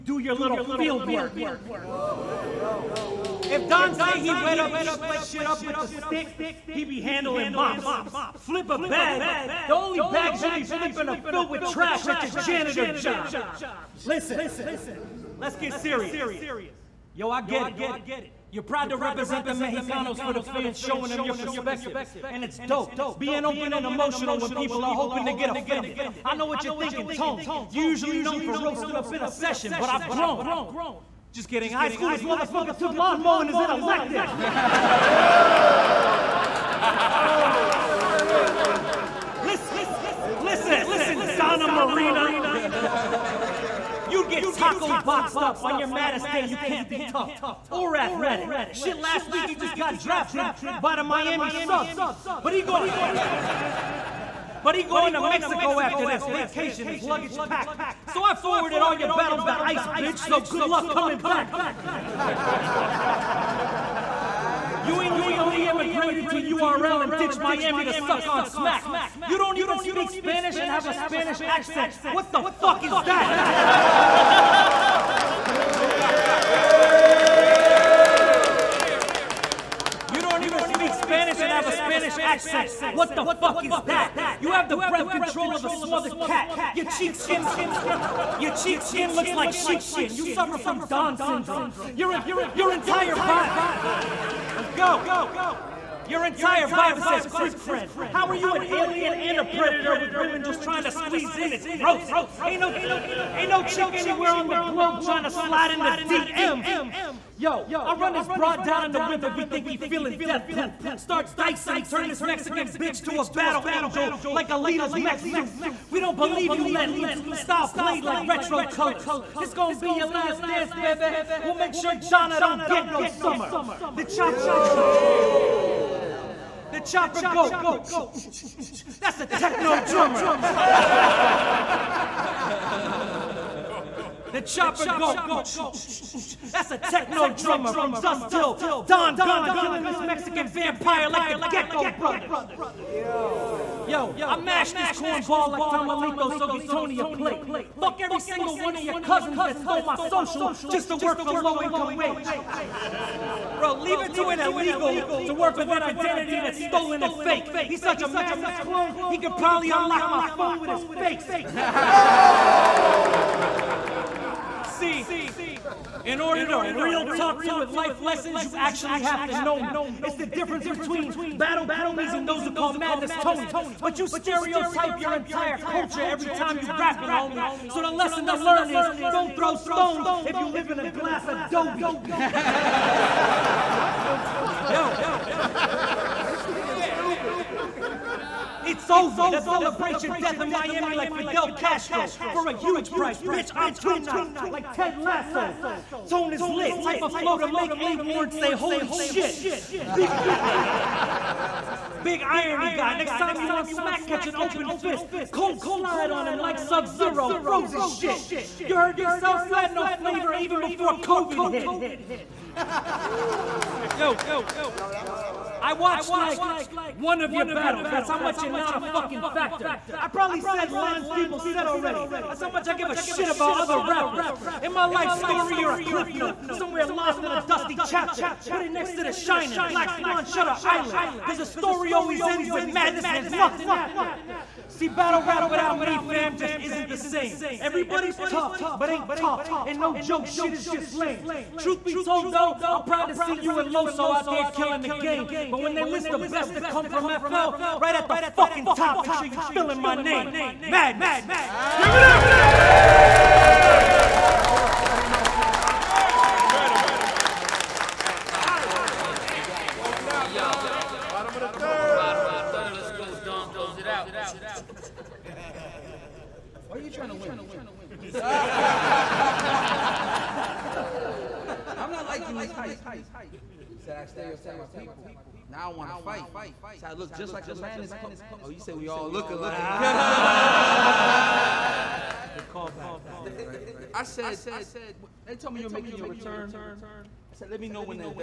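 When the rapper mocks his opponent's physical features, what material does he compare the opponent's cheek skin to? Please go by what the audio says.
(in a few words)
sheepskin.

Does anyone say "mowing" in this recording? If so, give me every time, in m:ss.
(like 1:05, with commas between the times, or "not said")
0:33.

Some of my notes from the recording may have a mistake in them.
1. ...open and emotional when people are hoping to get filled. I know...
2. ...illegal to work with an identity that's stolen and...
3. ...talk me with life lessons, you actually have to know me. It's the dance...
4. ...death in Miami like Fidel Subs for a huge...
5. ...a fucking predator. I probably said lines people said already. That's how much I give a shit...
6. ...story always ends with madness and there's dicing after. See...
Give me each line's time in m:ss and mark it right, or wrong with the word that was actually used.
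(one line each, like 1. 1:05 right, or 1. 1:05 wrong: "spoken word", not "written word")
1. 0:23 wrong: "offended", not "filled"
2. 2:34 right
3. 2:47 wrong: "difference", not "dance"
4. 3:10 wrong: "Castro", not "Subs"
5. 3:38 wrong: "factor", not "predator"
6. 3:51 wrong: "nothing", not "dicing".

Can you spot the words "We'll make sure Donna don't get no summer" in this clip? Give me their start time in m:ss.
2:01.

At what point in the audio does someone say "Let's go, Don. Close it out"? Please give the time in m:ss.
4:22.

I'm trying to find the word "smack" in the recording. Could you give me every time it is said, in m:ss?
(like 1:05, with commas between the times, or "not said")
1:08, 3:23.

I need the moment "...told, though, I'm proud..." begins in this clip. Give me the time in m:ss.
4:01.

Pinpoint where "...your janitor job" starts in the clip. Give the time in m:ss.
0:12.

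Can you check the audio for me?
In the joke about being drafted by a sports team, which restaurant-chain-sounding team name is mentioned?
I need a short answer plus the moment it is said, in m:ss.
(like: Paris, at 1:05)
Miami Subs, at 0:51.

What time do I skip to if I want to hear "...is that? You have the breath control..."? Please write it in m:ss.
1:23.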